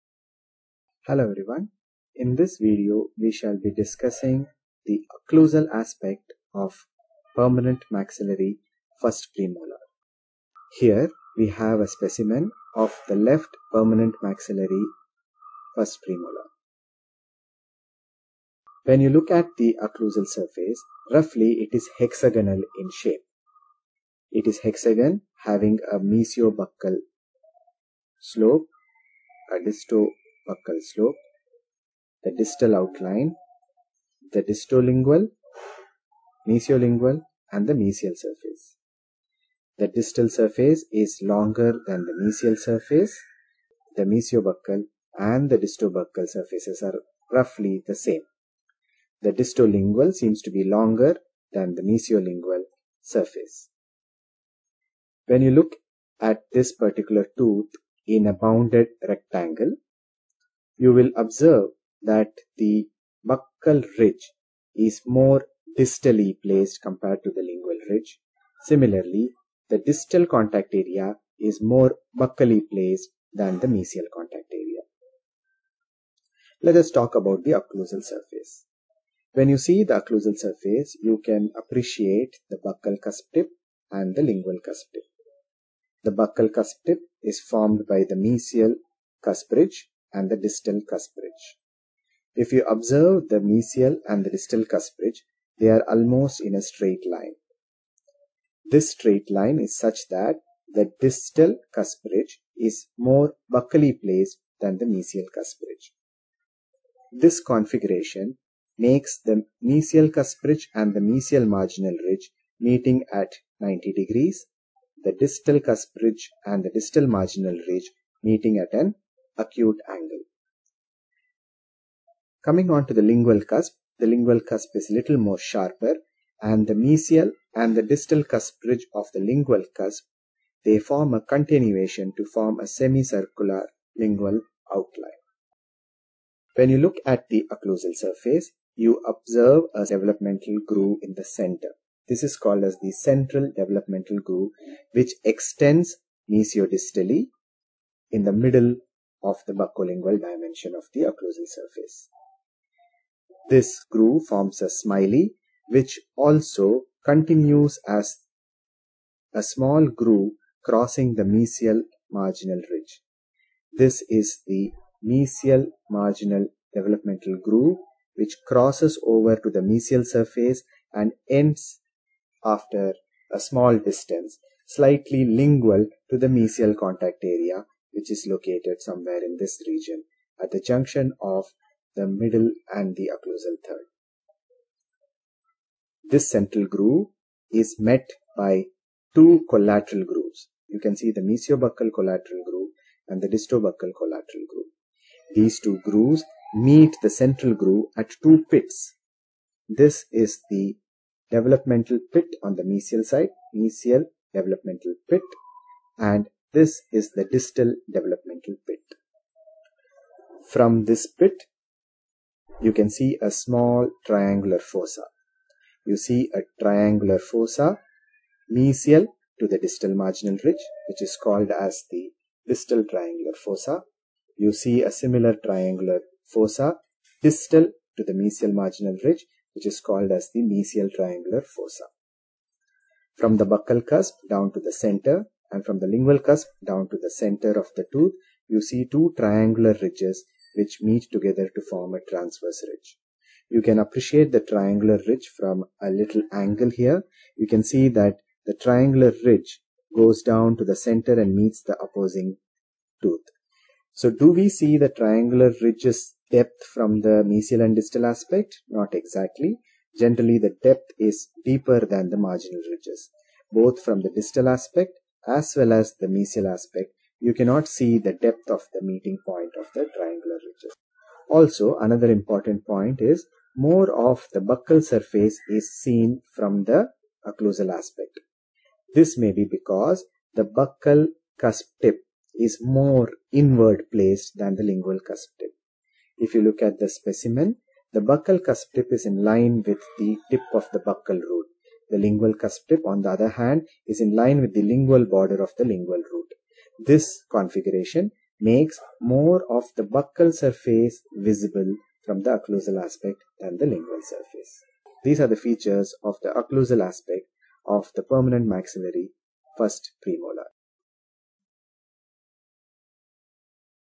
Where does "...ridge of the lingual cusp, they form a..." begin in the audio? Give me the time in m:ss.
2:08.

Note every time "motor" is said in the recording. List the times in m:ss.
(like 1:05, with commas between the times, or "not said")
not said.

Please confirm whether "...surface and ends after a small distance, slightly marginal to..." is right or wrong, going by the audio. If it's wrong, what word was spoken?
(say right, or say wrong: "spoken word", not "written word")
wrong: "lingual", not "marginal".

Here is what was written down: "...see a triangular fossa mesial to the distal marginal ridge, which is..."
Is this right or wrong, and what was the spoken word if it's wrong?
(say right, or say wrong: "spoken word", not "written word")
right.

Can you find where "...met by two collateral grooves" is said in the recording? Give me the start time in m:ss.
3:07.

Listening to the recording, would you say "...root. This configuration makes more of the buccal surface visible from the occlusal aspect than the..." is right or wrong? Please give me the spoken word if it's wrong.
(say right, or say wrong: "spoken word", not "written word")
right.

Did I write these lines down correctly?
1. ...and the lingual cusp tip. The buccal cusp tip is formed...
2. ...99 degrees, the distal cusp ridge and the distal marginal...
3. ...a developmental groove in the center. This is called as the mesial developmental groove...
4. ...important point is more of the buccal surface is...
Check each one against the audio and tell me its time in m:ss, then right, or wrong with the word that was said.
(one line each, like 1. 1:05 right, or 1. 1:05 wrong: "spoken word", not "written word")
1. 1:23 right
2. 1:53 wrong: "90", not "99"
3. 2:19 wrong: "central", not "mesial"
4. 4:32 right.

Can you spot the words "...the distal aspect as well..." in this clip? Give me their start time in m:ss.
4:23.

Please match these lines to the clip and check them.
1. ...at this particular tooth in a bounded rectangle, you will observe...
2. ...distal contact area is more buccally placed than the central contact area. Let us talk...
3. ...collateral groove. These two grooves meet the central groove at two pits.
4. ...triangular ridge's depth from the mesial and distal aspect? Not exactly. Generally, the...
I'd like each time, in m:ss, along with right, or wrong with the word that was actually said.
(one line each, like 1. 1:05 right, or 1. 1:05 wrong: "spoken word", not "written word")
1. 0:56 right
2. 1:09 wrong: "mesial", not "central"
3. 3:13 right
4. 4:14 right.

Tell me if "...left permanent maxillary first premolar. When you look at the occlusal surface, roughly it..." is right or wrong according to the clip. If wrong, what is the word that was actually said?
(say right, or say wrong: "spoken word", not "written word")
right.